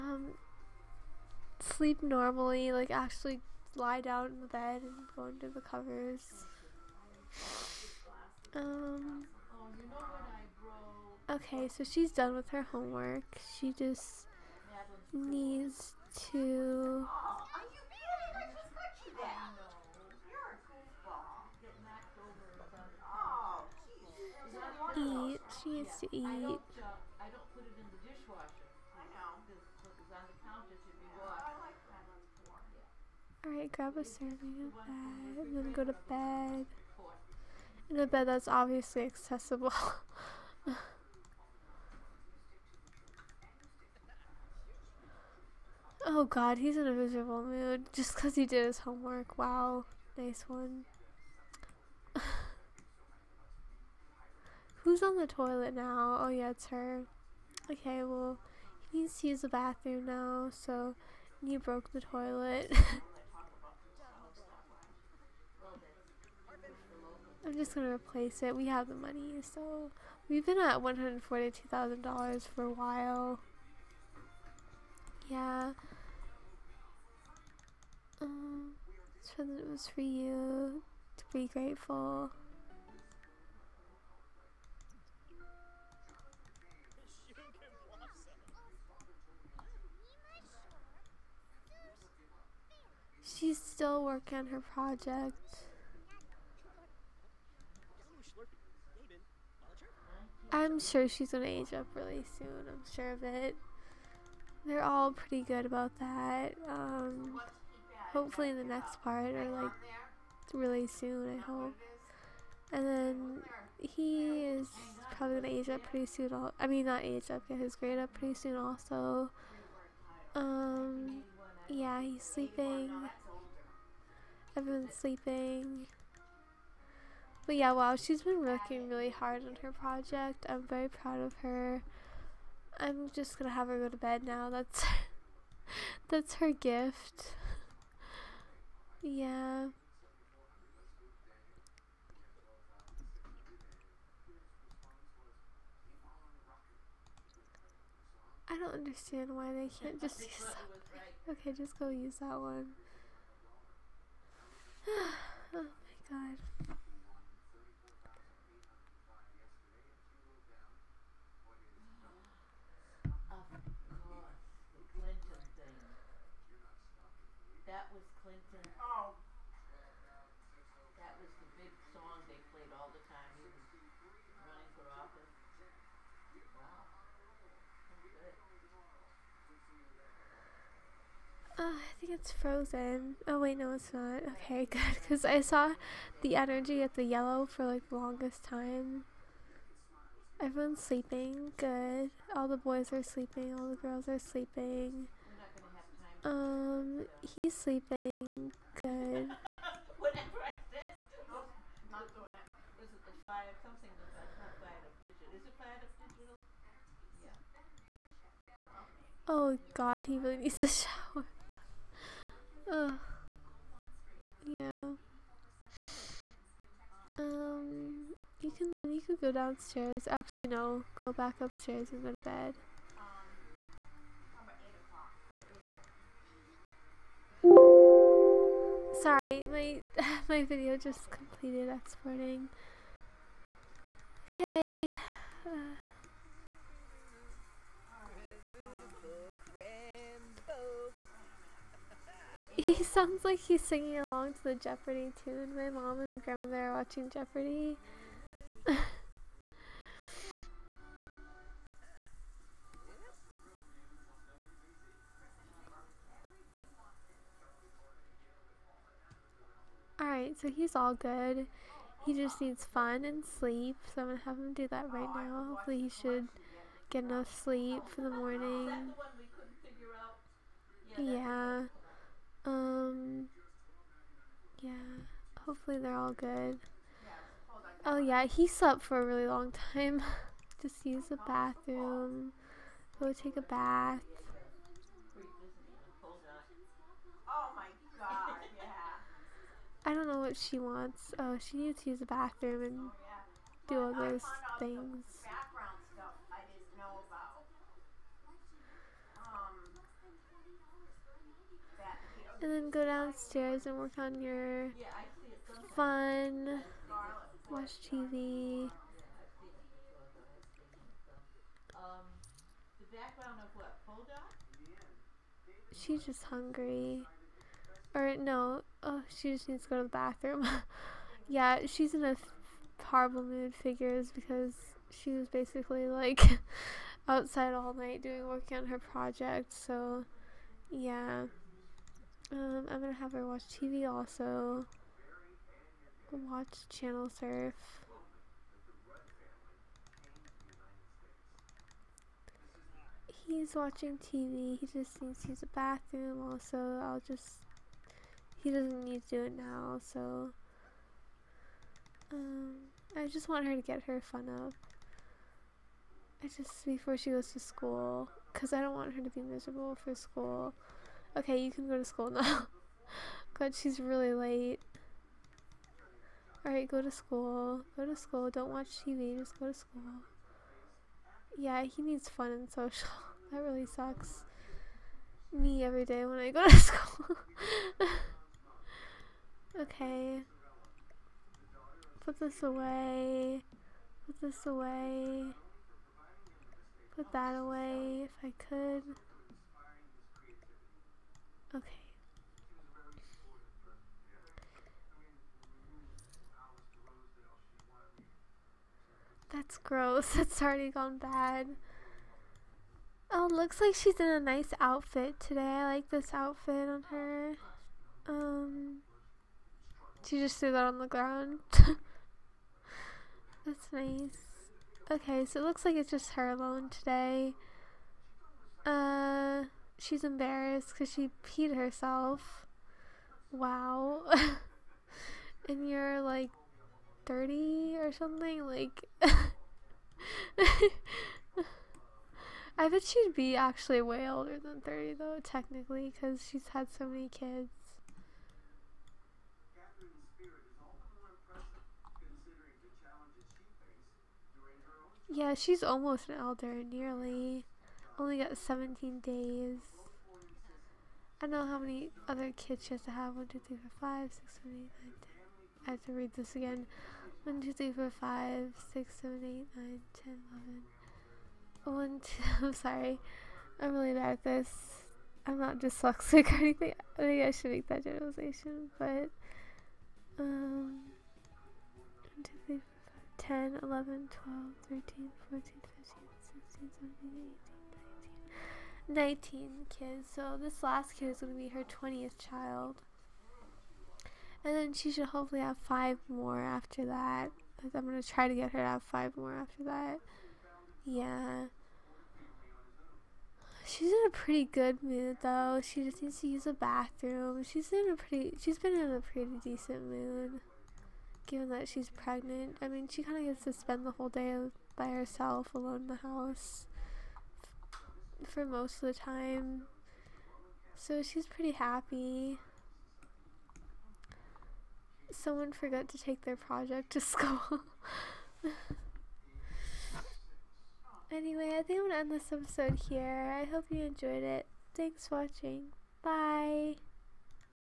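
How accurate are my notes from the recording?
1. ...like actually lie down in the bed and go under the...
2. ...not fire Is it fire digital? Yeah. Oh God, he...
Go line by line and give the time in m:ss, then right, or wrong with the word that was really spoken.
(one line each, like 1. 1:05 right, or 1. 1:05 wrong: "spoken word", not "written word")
1. 0:02 right
2. 3:23 right.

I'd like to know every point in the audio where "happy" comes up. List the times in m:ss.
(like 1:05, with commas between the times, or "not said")
8:31.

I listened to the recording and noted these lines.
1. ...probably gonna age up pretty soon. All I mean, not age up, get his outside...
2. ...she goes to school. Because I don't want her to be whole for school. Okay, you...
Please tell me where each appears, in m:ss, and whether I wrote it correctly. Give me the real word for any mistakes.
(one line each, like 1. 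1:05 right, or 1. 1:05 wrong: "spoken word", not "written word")
1. 1:55 wrong: "grade", not "outside"
2. 5:56 wrong: "miserable", not "whole".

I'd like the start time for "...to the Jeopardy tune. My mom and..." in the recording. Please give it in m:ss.
4:04.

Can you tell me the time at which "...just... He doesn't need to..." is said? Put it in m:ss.
5:47.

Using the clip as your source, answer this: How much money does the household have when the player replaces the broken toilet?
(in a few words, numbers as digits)
$142,000.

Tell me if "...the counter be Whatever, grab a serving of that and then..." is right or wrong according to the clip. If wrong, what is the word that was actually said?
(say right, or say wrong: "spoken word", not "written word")
wrong: "Alright", not "Whatever".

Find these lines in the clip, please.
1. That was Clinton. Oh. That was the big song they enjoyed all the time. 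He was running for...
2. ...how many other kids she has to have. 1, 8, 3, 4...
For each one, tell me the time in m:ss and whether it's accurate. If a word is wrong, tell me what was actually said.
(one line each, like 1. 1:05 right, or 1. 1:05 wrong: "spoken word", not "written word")
1. 2:47 wrong: "played", not "enjoyed"
2. 7:31 wrong: "2", not "8".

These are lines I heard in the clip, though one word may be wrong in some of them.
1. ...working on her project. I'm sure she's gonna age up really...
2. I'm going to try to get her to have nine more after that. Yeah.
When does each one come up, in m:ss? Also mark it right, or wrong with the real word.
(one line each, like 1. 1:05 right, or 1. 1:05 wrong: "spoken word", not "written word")
1. 1:34 right
2. 8:07 wrong: "five", not "nine".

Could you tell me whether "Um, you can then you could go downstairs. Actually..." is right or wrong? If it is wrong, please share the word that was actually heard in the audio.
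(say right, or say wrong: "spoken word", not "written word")
right.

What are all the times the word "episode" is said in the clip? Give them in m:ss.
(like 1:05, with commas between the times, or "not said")
8:42.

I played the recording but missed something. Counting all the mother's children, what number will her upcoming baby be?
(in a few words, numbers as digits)
20th.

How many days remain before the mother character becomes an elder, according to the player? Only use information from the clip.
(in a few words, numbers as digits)
17.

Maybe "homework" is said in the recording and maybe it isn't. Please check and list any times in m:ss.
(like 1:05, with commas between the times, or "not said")
0:12, 0:48.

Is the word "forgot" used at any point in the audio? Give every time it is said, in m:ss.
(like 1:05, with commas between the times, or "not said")
8:35.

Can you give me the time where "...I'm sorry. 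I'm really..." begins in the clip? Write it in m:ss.
7:42.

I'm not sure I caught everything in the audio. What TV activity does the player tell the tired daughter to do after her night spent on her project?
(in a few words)
Channel Surf.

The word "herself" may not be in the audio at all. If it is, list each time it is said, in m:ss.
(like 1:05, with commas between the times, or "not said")
7:01, 8:24.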